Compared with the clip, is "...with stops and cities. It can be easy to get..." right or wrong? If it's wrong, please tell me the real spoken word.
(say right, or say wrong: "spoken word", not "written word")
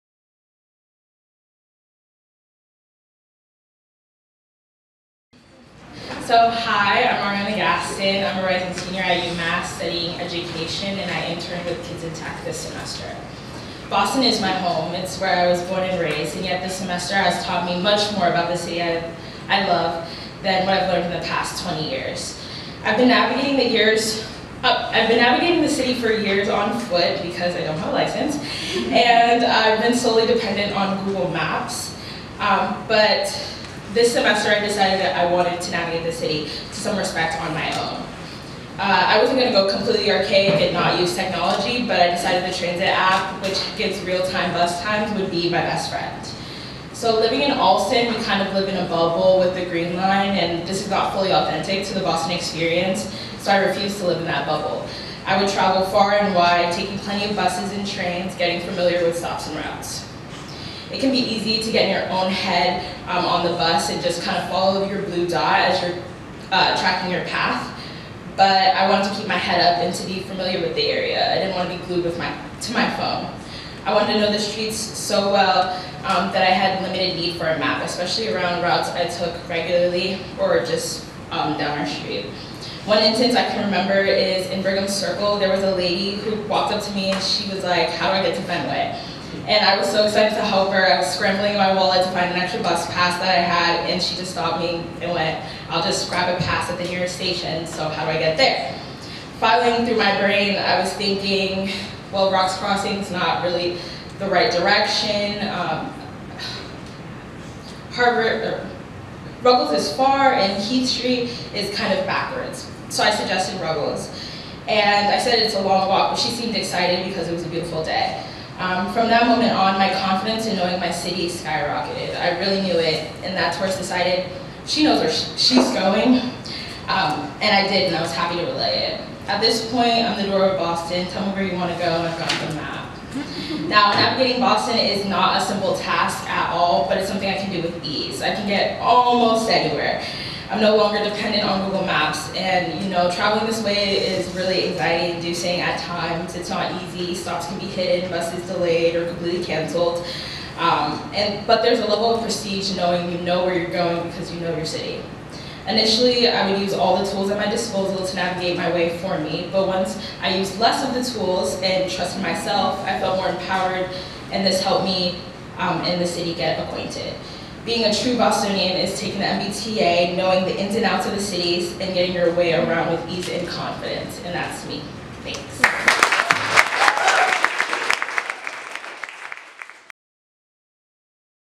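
wrong: "routes", not "cities".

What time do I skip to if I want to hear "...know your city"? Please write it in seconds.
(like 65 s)
154 s.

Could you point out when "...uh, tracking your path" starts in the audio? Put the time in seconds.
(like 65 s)
66 s.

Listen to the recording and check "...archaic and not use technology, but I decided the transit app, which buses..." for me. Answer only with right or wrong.
wrong.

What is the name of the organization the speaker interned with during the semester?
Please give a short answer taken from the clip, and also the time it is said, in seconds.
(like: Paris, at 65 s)
Kids in Tech, at 11 s.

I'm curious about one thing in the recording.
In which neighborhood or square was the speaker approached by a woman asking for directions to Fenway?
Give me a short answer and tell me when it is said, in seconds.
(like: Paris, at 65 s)
Brigham Circle, at 84 s.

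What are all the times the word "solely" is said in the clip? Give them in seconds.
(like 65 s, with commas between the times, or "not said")
29 s.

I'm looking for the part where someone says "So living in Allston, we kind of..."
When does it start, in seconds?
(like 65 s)
46 s.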